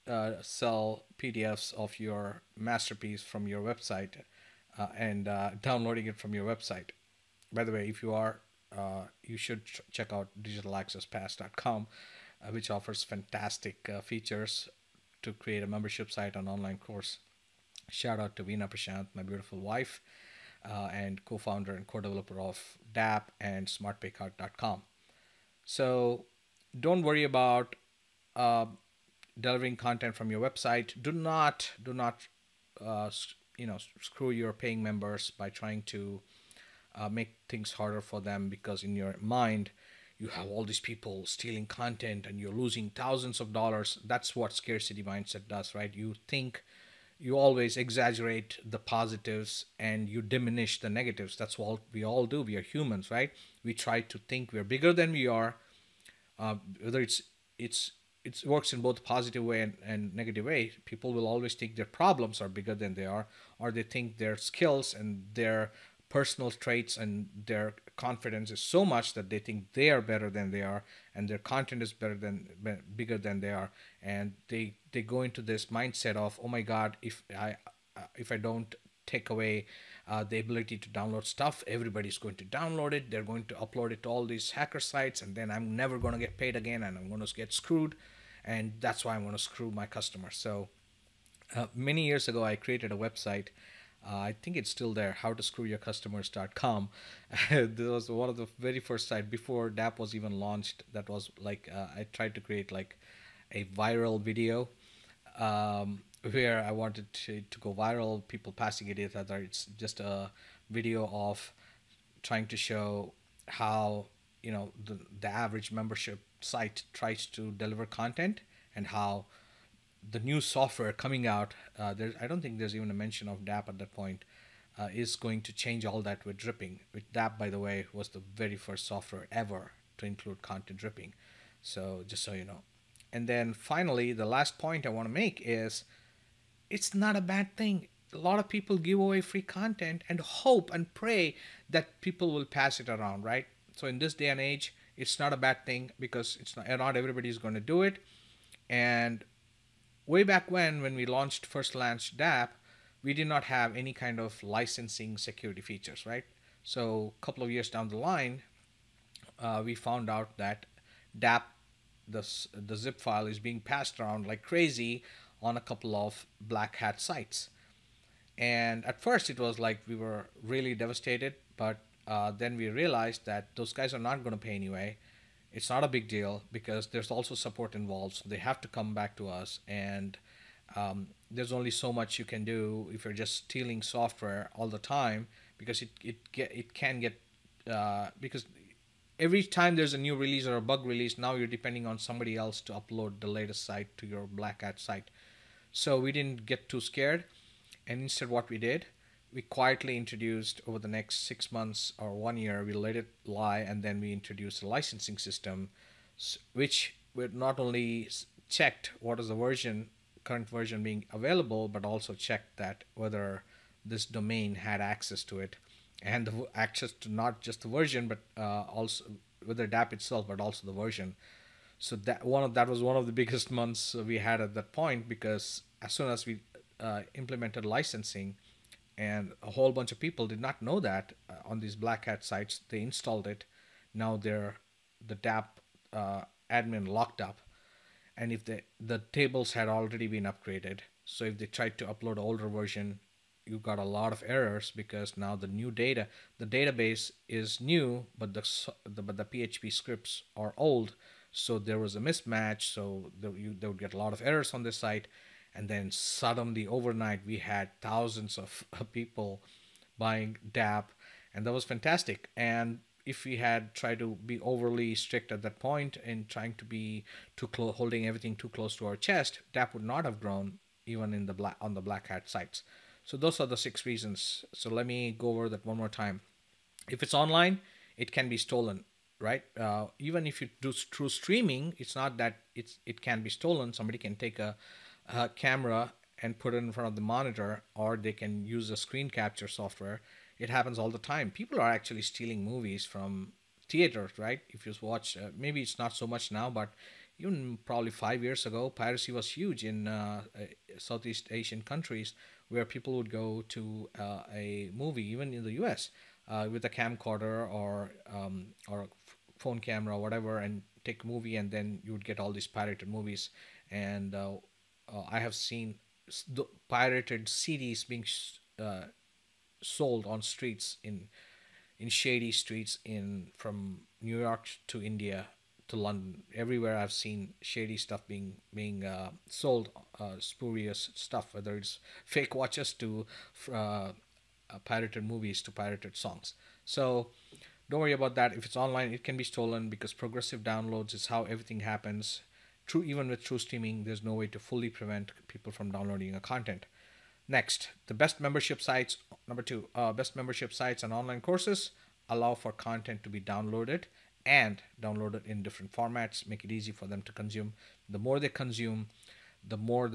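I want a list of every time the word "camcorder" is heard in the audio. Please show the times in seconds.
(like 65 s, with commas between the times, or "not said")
306 s.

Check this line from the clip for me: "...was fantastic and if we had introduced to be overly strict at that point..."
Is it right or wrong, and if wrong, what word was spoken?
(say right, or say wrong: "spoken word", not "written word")
wrong: "tried", not "introduced".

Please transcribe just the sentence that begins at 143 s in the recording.
So in this day and age, it's not a bad thing because it's not, not everybody is going to do it.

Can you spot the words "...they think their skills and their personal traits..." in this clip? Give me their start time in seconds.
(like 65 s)
63 s.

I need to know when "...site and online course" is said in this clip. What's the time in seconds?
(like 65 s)
16 s.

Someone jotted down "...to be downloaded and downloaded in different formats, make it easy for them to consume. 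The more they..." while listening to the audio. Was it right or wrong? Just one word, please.
right.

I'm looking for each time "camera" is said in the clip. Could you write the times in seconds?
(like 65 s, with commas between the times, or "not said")
285 s, 309 s.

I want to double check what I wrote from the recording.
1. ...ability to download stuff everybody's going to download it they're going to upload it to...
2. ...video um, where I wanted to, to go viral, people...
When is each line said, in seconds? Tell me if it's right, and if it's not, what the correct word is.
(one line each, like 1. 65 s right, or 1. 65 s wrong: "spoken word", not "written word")
1. 80 s right
2. 104 s right.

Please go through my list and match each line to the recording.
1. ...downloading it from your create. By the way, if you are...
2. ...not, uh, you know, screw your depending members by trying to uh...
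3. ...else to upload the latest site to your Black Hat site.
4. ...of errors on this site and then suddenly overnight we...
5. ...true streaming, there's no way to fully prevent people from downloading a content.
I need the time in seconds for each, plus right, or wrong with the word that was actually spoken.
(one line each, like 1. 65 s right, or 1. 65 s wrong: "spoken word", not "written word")
1. 5 s wrong: "website", not "create"
2. 31 s wrong: "paying", not "depending"
3. 192 s right
4. 254 s right
5. 343 s right.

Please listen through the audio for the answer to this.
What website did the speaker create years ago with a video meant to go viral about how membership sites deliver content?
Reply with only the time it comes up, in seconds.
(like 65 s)
95 s.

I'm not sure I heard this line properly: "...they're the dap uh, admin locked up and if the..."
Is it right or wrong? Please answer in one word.
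right.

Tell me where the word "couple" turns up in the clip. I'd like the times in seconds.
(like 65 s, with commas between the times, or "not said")
157 s, 165 s.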